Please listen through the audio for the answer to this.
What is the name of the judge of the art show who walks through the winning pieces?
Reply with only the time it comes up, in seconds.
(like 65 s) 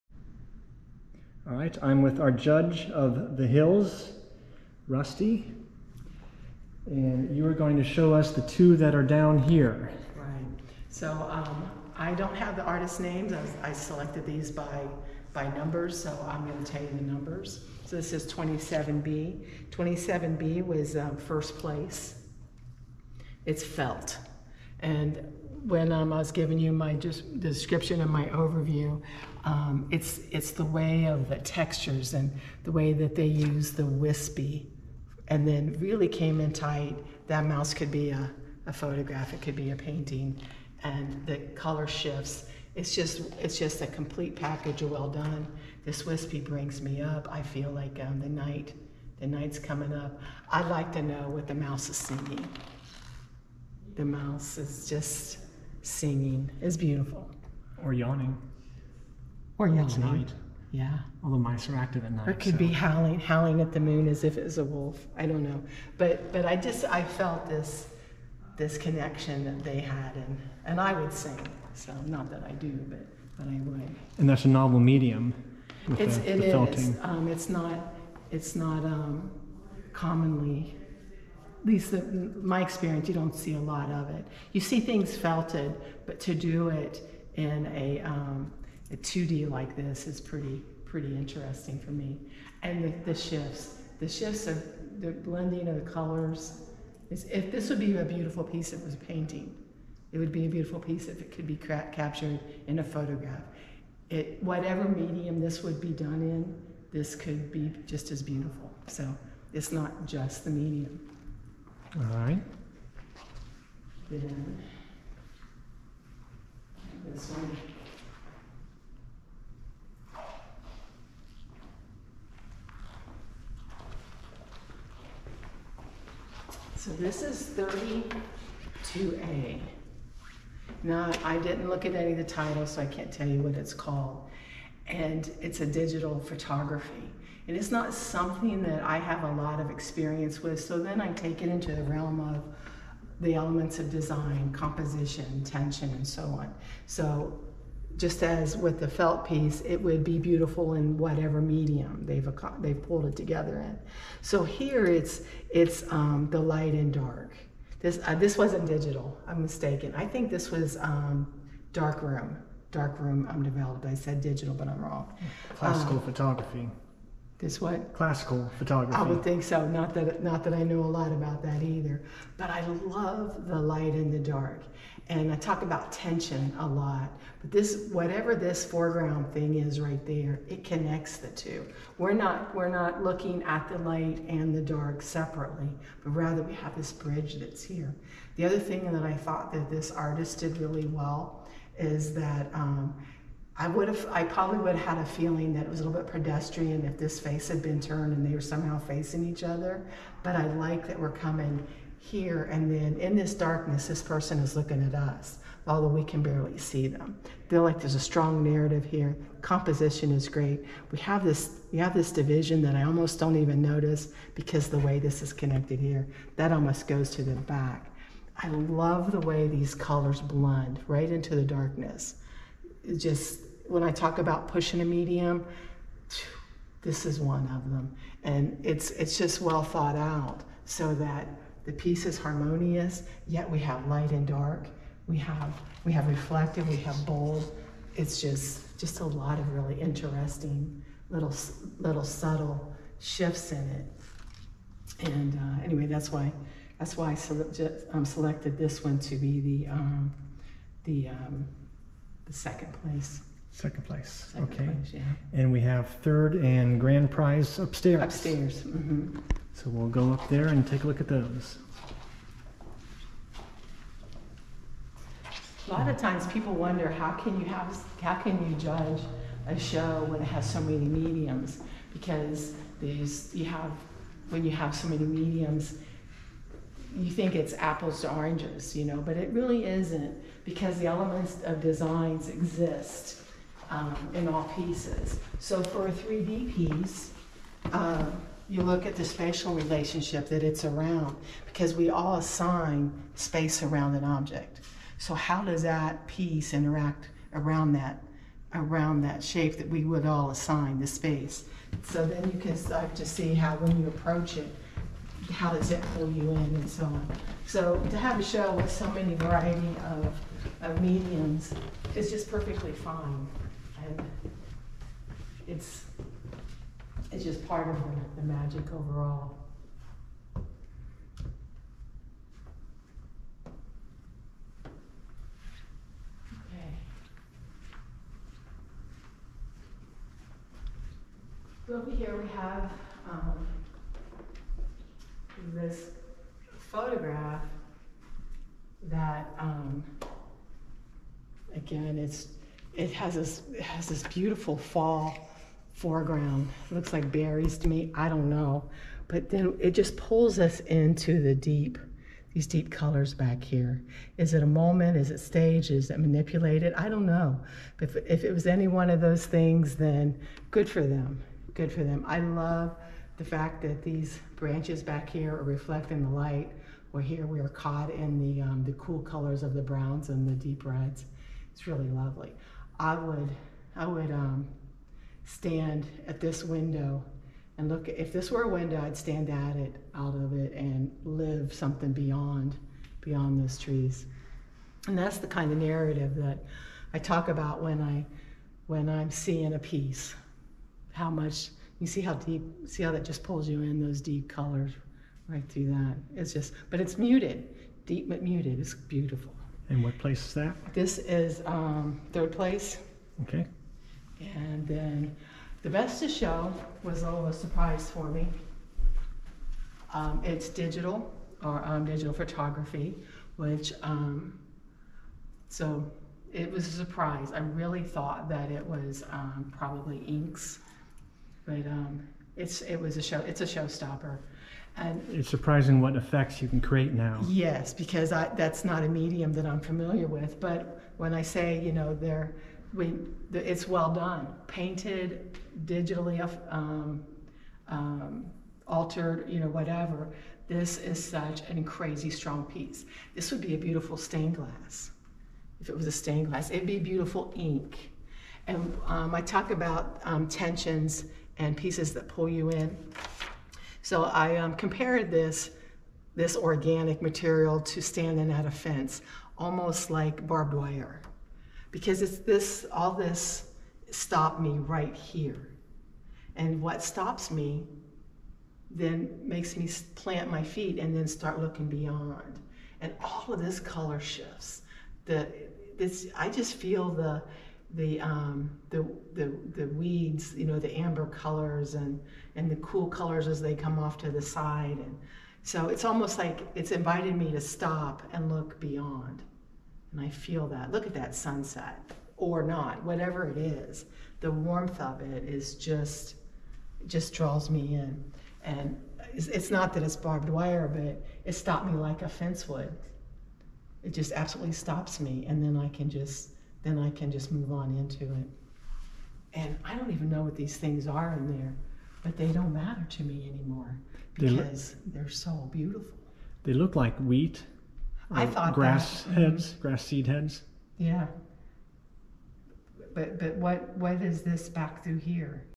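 4 s.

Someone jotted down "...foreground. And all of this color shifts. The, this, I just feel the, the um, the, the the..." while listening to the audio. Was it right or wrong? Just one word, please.
wrong.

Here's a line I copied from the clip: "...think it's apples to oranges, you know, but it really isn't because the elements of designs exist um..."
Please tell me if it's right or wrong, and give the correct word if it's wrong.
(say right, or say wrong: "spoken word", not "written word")
right.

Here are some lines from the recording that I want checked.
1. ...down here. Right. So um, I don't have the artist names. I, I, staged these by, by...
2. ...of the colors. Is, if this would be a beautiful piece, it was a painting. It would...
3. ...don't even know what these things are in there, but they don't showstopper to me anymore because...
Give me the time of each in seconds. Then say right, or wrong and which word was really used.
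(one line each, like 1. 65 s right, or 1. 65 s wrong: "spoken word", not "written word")
1. 9 s wrong: "selected", not "staged"
2. 95 s right
3. 509 s wrong: "matter", not "showstopper".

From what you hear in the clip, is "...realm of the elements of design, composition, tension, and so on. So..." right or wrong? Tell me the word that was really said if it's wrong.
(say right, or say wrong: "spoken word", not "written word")
right.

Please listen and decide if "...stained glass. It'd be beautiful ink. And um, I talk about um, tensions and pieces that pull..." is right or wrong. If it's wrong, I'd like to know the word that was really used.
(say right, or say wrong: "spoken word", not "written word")
right.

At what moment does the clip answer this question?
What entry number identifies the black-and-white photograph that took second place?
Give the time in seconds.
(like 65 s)
128 s.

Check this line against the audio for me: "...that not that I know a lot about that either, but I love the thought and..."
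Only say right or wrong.
wrong.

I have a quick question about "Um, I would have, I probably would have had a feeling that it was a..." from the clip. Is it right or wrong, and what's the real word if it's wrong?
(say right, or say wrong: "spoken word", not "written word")
right.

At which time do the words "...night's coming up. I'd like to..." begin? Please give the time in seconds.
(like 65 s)
49 s.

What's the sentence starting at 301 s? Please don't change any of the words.
So then you can start to see how when you approach it, how does that pull you in and so on.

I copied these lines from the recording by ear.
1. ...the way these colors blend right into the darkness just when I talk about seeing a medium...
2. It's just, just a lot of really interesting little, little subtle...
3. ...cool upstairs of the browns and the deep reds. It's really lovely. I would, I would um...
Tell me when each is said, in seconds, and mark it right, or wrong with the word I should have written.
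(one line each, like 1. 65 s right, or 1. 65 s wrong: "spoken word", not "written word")
1. 219 s wrong: "pushing", not "seeing"
2. 237 s right
3. 368 s wrong: "colors", not "upstairs".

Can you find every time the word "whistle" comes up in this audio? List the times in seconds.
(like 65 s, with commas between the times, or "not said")
not said.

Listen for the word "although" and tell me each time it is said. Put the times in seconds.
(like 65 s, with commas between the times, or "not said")
61 s, 205 s.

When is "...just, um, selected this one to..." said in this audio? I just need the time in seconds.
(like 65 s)
247 s.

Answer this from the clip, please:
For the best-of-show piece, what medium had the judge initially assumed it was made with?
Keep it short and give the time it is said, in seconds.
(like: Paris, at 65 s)
Inks, at 420 s.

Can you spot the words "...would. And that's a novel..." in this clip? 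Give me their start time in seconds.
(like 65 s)
73 s.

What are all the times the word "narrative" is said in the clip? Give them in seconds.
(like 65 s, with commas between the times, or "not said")
208 s, 385 s.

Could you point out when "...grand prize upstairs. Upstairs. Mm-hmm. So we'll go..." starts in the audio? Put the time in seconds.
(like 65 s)
256 s.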